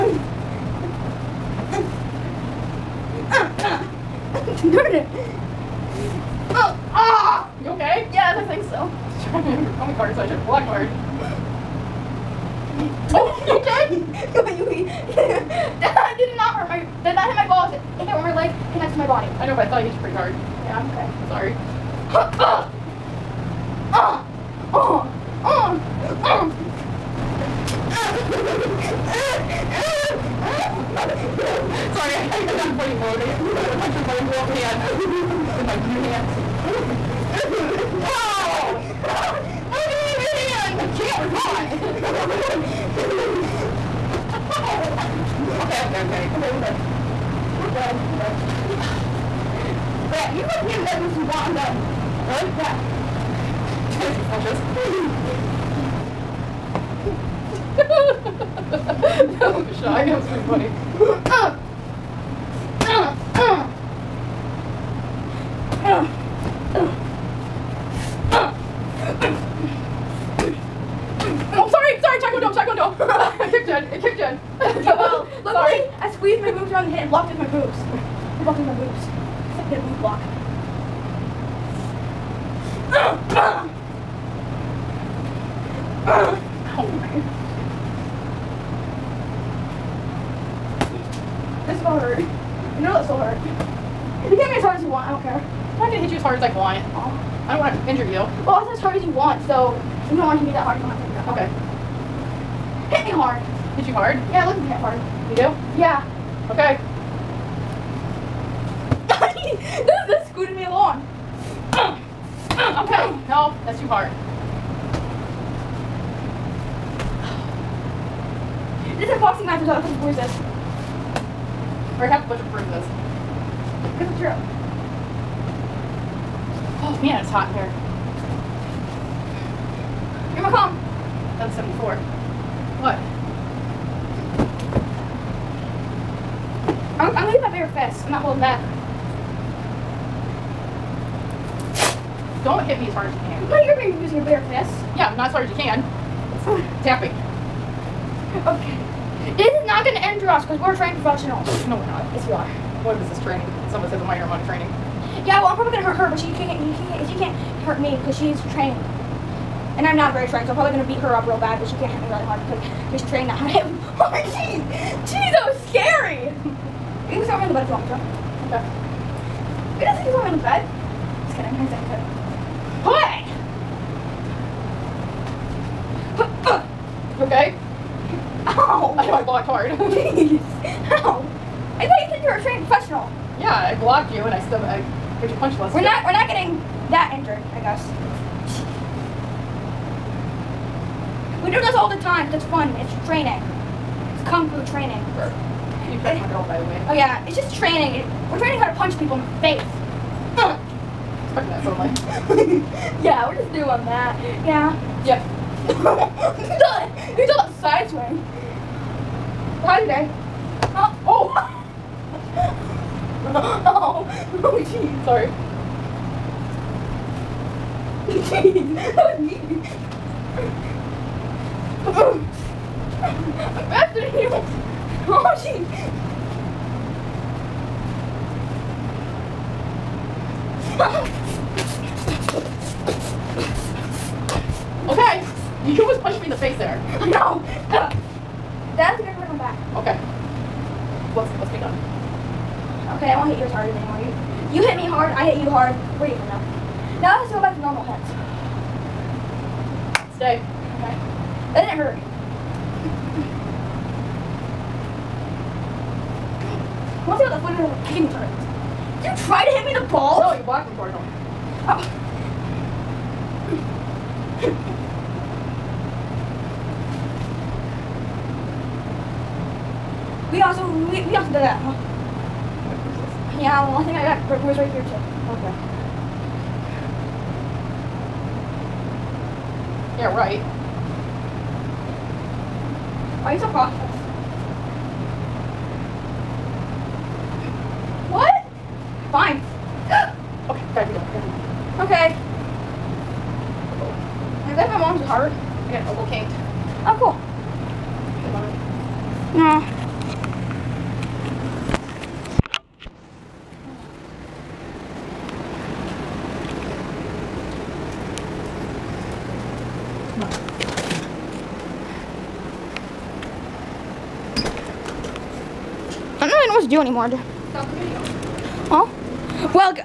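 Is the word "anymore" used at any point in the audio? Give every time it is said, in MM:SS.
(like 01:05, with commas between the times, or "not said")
04:03, 05:16.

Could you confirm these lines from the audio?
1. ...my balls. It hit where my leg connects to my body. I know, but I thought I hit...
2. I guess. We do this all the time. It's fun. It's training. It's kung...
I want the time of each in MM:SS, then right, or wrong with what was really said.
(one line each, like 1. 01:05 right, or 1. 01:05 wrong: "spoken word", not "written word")
1. 00:17 right
2. 03:07 right.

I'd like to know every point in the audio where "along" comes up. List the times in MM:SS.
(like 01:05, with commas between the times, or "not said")
01:50.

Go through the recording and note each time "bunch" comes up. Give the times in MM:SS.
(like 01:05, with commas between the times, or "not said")
02:02.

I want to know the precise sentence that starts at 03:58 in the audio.
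That's a good one on my back.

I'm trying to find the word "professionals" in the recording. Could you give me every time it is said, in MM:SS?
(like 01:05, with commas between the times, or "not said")
02:31, 03:02.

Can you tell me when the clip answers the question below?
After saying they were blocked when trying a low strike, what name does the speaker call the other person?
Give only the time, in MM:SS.
04:20.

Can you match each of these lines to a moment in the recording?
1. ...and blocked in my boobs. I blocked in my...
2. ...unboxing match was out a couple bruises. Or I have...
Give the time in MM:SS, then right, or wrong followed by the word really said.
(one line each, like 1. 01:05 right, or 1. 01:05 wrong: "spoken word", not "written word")
1. 01:16 right
2. 01:59 right.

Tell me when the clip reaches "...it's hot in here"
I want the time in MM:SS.
02:07.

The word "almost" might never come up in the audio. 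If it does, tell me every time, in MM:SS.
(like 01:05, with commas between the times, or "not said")
03:55, 05:16.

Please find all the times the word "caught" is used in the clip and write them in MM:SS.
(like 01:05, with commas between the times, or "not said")
00:41.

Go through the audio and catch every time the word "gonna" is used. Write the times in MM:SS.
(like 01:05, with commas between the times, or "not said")
01:35, 02:17.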